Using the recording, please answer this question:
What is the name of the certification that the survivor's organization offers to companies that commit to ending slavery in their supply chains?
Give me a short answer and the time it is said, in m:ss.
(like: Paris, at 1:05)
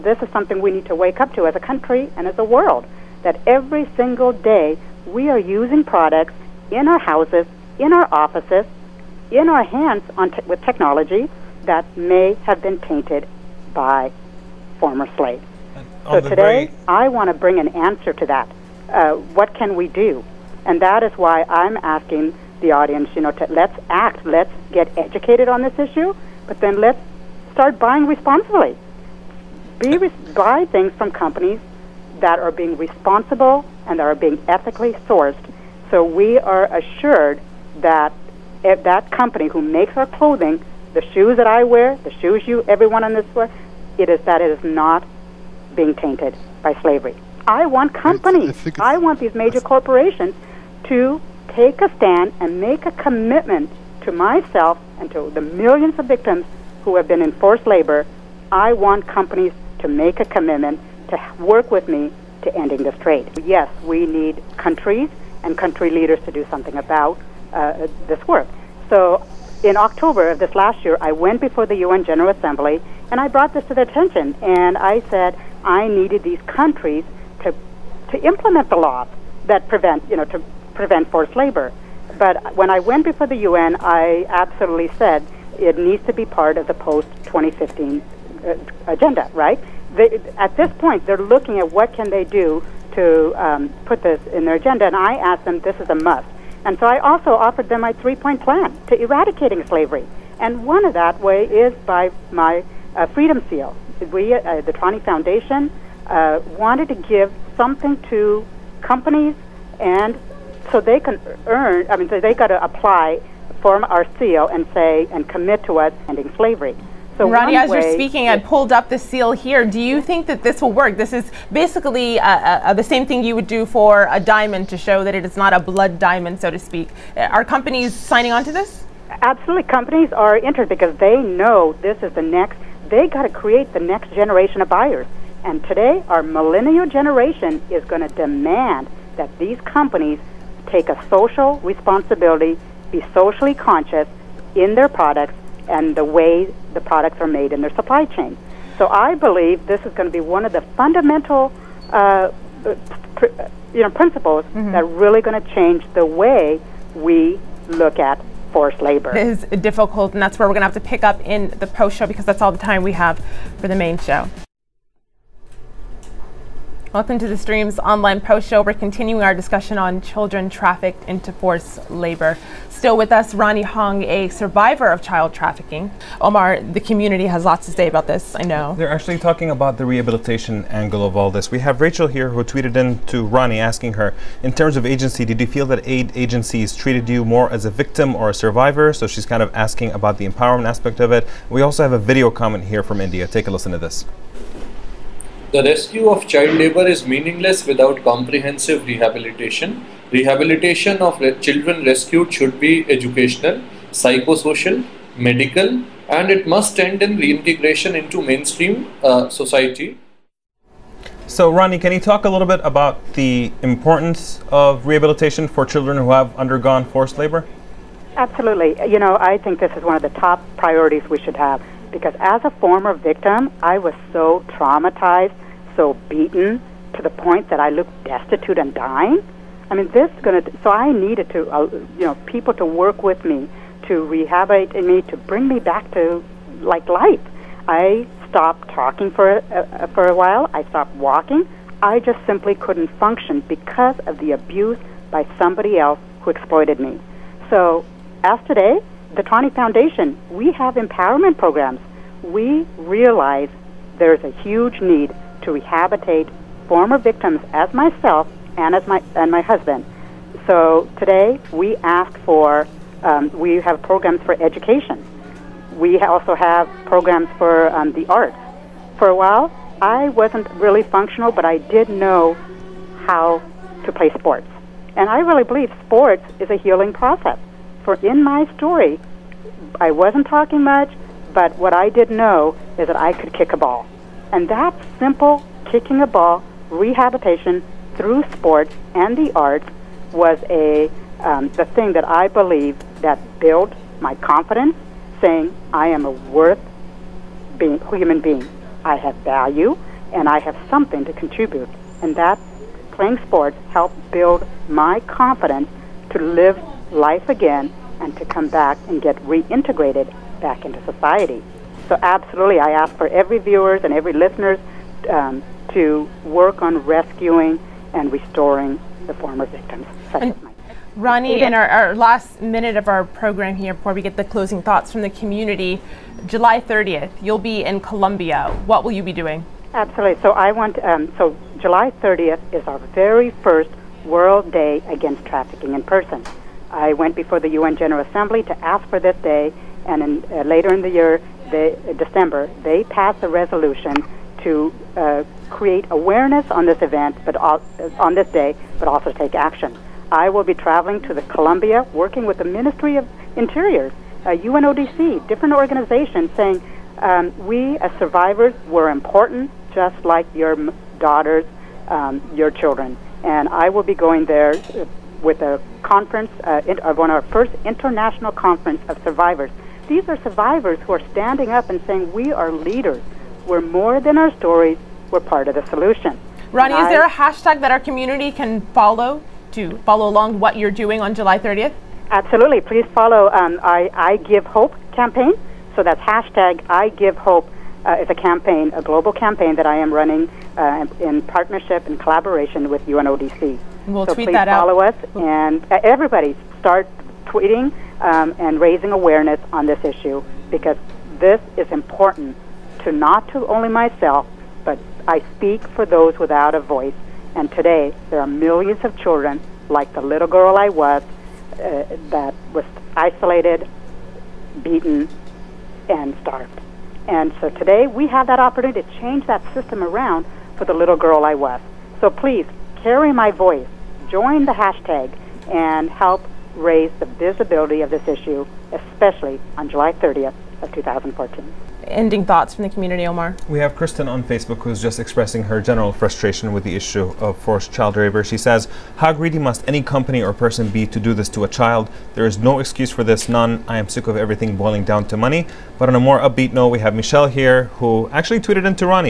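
Freedom Seal, at 1:43.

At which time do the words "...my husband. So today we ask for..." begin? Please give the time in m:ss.
4:19.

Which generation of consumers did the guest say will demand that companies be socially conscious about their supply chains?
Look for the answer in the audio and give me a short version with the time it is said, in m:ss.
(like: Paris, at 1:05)
millennial generation, at 2:16.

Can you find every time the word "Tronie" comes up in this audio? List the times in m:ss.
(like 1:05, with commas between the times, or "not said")
1:44, 4:09.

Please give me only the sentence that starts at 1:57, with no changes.
So Rani, as you're speaking, I pulled up the seal here.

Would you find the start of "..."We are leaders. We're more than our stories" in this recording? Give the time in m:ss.
6:12.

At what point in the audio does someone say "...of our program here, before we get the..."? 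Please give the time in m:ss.
5:22.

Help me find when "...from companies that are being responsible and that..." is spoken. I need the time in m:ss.
0:30.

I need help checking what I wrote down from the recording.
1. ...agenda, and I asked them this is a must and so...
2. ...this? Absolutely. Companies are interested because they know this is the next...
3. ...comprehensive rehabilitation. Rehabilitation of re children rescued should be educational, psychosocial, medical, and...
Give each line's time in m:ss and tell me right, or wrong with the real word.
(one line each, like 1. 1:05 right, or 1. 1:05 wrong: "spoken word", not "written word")
1. 1:34 right
2. 2:08 right
3. 3:18 right.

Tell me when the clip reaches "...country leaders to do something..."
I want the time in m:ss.
1:05.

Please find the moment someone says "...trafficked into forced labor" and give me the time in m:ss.
2:50.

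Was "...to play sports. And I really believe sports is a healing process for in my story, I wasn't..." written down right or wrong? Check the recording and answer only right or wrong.
right.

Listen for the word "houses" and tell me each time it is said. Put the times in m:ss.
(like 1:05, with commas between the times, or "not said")
0:06.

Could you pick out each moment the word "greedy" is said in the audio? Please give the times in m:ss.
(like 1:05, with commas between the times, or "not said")
7:19.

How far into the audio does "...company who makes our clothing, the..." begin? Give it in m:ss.
0:39.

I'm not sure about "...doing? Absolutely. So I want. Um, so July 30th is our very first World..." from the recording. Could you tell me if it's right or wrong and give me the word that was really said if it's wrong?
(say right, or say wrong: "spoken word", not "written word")
right.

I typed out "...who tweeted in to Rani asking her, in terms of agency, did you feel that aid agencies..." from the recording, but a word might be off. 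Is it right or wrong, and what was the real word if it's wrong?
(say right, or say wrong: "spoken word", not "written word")
wrong: "Ronnie", not "Rani".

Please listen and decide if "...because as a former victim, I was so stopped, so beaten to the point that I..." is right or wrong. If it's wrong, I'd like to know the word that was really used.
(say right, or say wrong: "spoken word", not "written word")
wrong: "traumatized", not "stopped".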